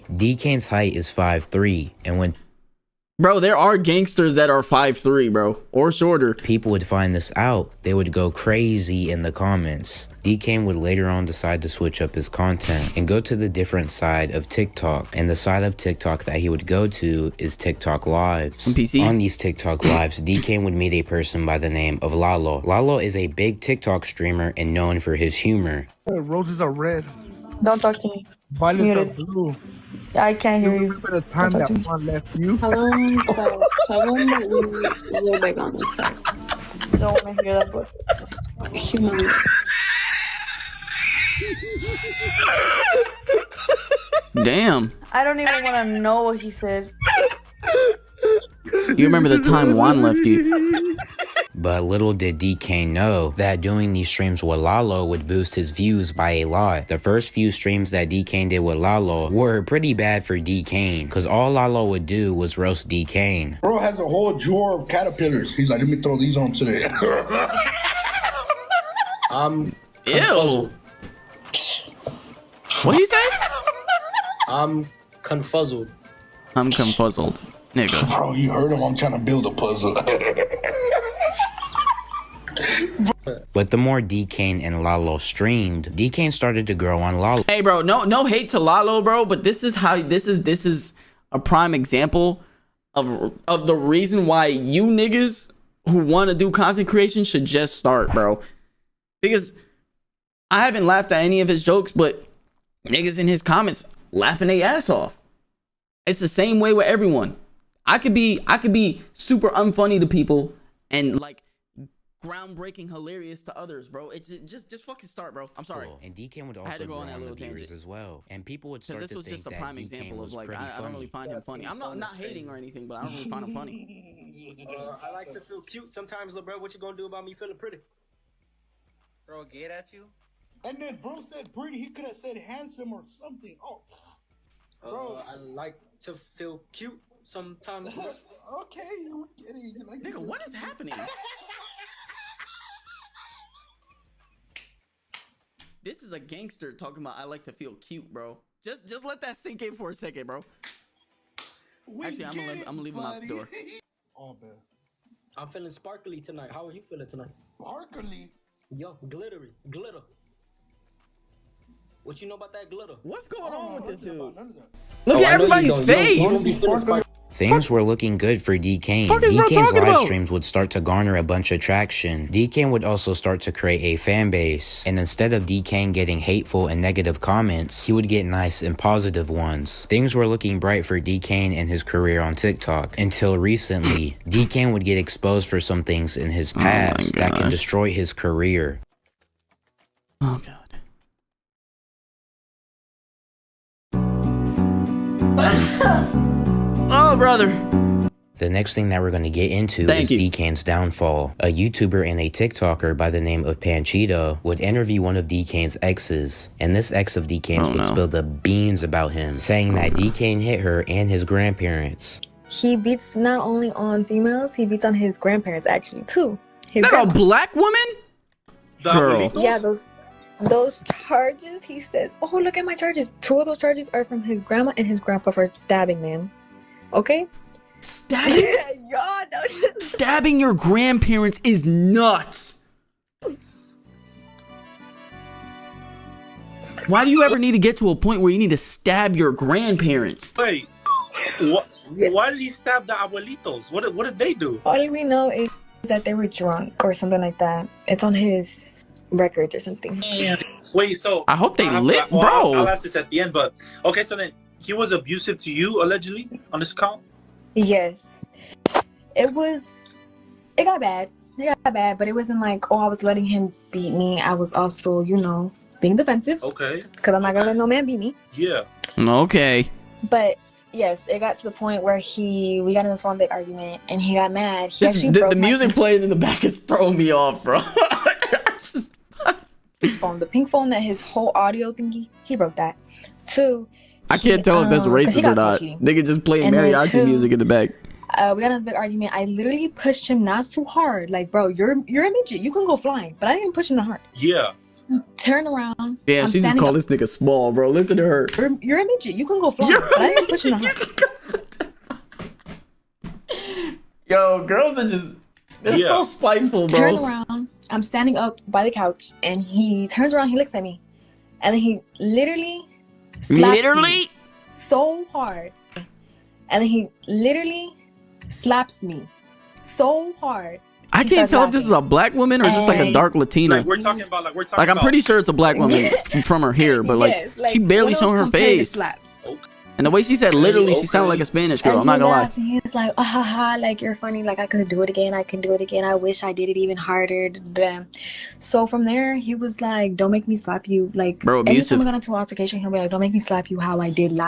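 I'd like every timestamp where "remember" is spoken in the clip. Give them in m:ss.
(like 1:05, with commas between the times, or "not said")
0:30, 0:49.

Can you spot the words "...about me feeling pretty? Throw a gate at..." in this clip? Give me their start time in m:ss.
2:07.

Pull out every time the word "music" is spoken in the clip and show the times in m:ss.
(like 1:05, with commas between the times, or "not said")
4:35, 4:47.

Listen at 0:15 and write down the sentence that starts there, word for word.
And the side of TikTok that he would go to is TikTok Lives.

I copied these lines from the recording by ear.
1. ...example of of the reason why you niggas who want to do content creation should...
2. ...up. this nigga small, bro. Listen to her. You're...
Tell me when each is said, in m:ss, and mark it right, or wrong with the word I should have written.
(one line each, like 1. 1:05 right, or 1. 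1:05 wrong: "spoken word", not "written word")
1. 1:31 right
2. 4:56 right.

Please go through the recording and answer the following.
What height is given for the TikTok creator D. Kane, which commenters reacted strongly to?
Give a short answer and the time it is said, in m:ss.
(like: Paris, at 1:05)
5'3", at 0:01.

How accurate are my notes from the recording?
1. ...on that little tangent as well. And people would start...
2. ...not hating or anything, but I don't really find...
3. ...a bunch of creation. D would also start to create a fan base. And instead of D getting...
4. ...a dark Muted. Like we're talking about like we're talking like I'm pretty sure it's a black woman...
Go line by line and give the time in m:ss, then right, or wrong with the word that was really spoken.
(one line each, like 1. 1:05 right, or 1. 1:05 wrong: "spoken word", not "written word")
1. 1:56 right
2. 2:01 right
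3. 2:51 wrong: "traction", not "creation"
4. 5:22 wrong: "Latina", not "Muted".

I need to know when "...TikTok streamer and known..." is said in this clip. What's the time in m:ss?
0:23.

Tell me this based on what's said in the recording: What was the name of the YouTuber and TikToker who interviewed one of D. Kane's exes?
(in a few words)
Panchita.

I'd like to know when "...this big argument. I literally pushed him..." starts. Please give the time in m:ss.
4:48.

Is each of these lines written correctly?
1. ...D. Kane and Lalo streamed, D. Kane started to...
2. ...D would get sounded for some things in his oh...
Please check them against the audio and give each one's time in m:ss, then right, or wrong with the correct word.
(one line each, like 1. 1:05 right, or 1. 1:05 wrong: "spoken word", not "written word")
1. 1:24 right
2. 3:04 wrong: "exposed", not "sounded".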